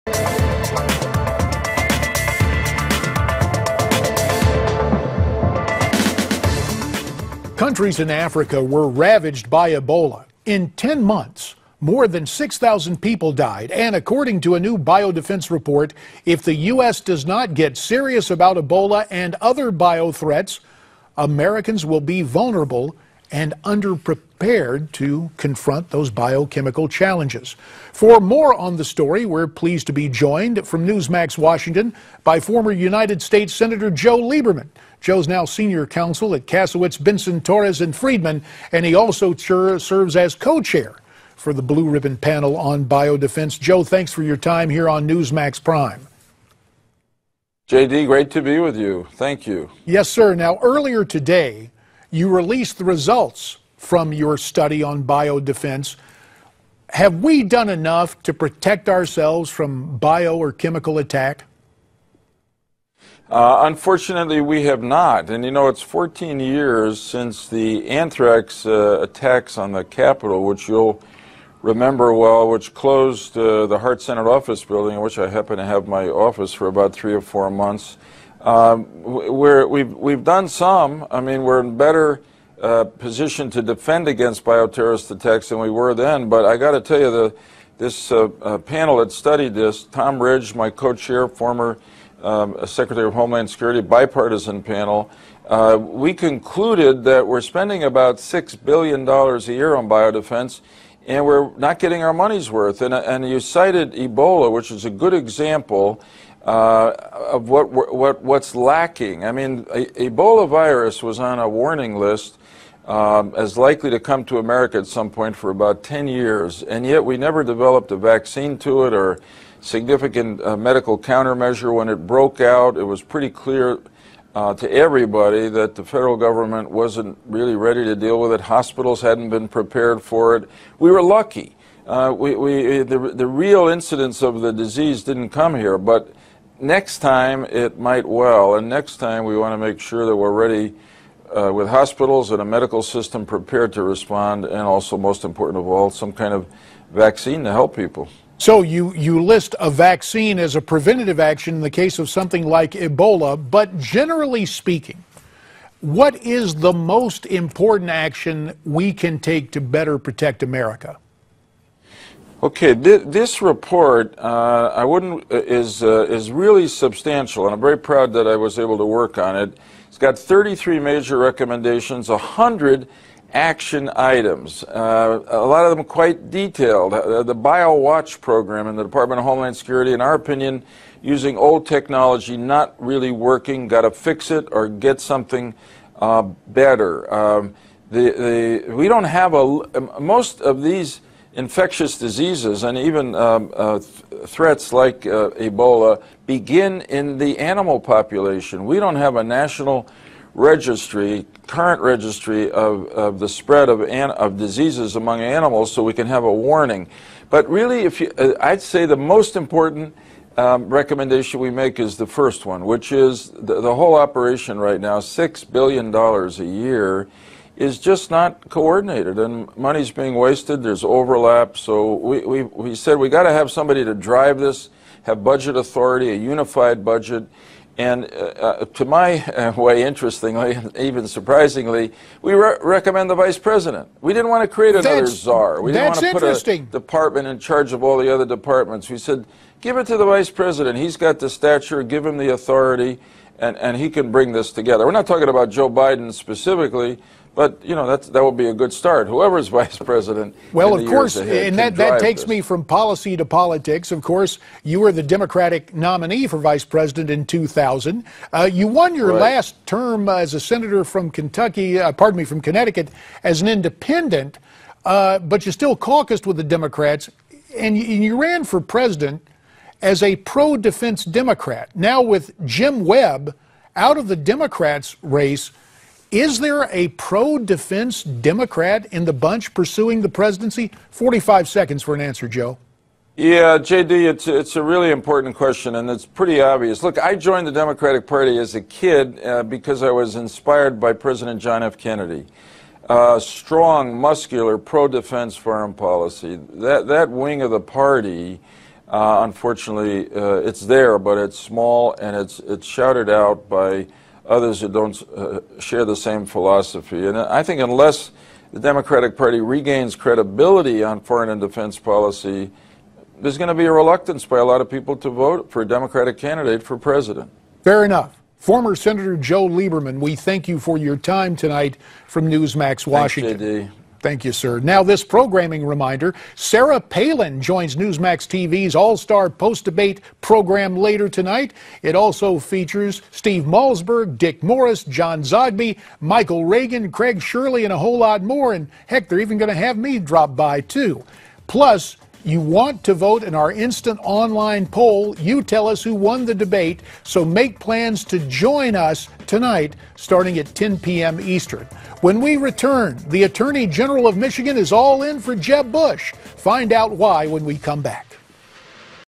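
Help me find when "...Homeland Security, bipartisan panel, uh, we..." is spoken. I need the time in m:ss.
1:33.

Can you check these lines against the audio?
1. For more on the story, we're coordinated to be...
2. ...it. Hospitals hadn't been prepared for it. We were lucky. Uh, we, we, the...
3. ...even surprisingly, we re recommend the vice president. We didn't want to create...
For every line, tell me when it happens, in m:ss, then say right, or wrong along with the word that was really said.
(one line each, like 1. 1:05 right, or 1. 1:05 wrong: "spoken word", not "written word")
1. 0:27 wrong: "pleased", not "coordinated"
2. 2:08 right
3. 3:50 right.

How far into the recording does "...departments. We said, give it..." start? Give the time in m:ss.
3:58.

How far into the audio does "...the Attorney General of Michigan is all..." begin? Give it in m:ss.
5:53.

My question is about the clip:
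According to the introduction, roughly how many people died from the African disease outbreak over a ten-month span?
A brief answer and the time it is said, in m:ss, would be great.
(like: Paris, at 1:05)
6,000, at 0:12.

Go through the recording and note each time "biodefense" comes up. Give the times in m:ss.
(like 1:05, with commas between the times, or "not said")
0:14, 0:42, 0:55, 1:39.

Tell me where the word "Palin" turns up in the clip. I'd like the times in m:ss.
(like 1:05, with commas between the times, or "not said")
5:26.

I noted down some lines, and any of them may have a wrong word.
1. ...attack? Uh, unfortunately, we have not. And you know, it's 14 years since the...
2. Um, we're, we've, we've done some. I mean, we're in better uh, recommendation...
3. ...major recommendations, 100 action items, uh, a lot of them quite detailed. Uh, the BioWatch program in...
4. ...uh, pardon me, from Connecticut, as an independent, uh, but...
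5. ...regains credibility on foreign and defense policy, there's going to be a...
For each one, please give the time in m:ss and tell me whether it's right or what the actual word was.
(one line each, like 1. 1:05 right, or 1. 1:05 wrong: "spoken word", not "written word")
1. 1:00 right
2. 1:18 wrong: "position", not "recommendation"
3. 2:50 right
4. 4:21 right
5. 5:09 right.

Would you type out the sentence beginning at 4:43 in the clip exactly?
Yeah, JD, it's, it's a really important question, and it's pretty obvious.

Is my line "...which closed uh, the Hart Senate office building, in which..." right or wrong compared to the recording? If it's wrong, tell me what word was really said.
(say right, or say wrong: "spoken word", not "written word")
right.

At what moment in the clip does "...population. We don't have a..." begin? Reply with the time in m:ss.
3:17.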